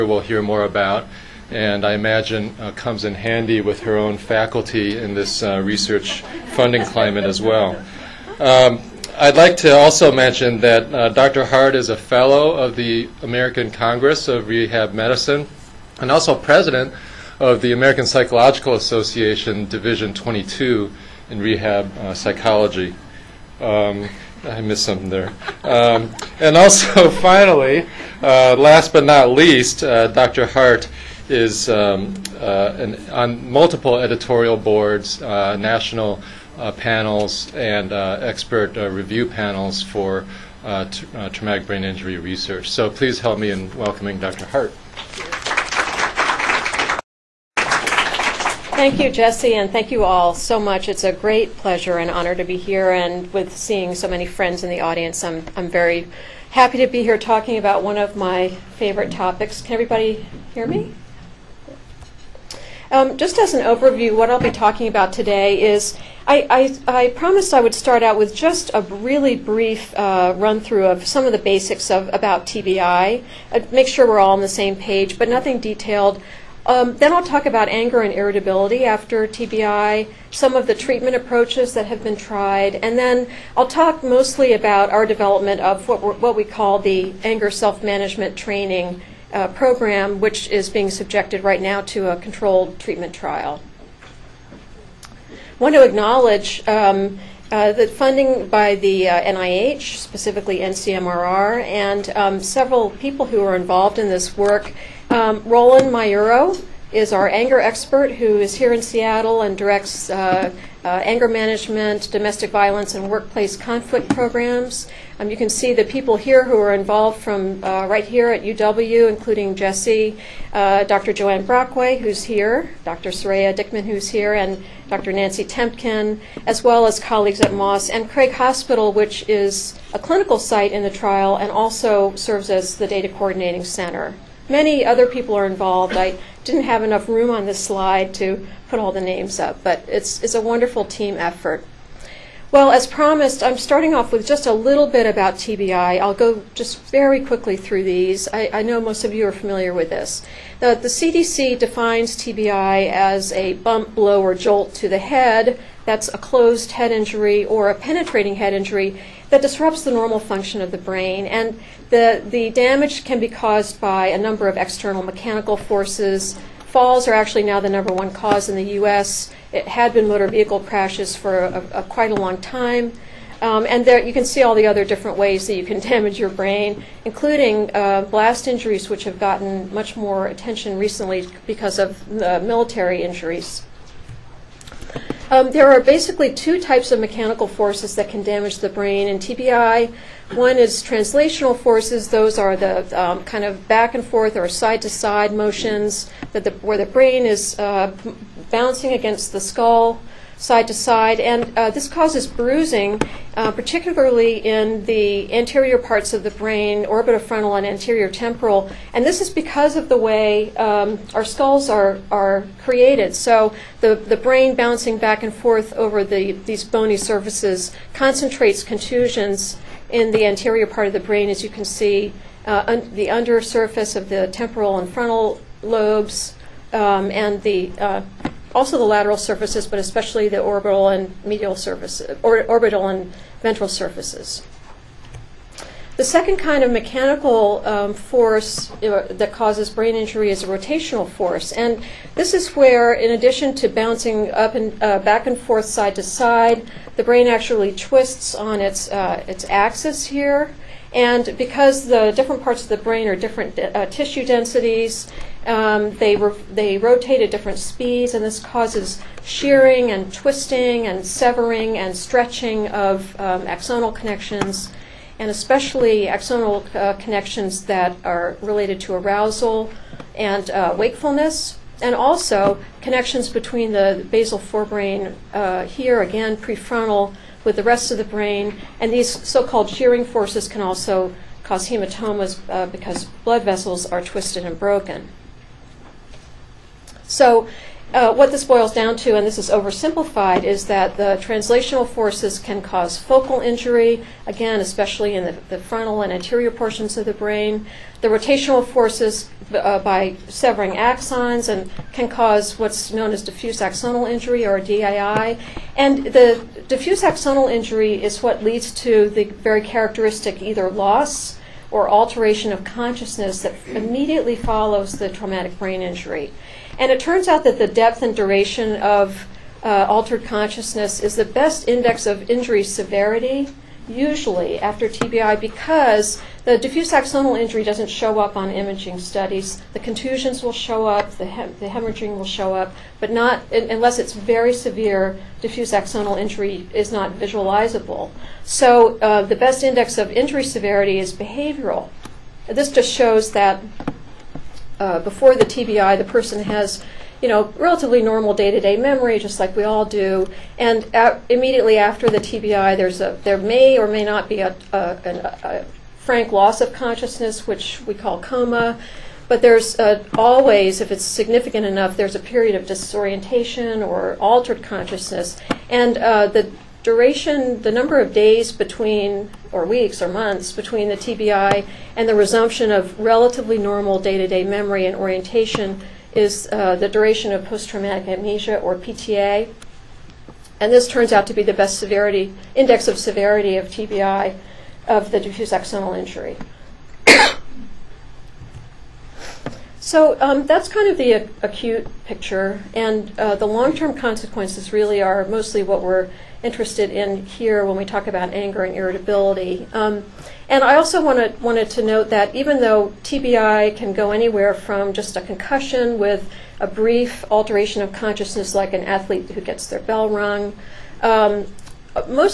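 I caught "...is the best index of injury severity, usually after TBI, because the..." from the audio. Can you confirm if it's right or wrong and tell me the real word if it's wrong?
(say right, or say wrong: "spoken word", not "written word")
right.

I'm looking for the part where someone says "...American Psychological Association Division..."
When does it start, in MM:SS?
00:17.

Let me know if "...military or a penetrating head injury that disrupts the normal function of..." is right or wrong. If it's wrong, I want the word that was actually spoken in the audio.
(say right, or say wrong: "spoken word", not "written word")
wrong: "injury", not "military".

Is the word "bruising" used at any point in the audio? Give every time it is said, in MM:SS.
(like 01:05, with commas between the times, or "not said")
03:22.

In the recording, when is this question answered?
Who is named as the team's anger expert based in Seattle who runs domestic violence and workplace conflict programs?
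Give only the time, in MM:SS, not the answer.
01:45.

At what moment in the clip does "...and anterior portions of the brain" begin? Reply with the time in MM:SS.
04:56.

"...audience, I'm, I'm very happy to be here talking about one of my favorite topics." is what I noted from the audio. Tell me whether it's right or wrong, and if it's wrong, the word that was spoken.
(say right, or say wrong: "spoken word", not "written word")
right.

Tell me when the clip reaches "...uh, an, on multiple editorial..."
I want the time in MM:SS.
00:32.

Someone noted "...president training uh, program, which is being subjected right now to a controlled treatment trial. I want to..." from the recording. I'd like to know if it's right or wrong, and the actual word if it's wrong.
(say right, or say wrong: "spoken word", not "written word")
wrong: "management", not "president".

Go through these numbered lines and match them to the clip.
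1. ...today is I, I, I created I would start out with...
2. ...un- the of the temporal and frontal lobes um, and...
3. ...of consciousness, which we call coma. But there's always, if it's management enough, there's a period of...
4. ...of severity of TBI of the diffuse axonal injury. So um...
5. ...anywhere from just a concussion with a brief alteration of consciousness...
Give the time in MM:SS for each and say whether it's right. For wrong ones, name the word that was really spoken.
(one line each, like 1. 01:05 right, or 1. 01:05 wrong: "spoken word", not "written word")
1. 01:05 wrong: "promised", not "created"
2. 03:42 right
3. 05:56 wrong: "significant", not "management"
4. 06:22 right
5. 06:44 right.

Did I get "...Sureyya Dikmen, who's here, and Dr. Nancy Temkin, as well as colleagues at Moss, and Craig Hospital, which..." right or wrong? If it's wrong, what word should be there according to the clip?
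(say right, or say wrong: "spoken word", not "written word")
right.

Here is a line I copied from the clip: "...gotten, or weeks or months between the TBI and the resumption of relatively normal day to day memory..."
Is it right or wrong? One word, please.
wrong.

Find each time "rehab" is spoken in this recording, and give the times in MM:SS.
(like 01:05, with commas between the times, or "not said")
00:14, 00:21.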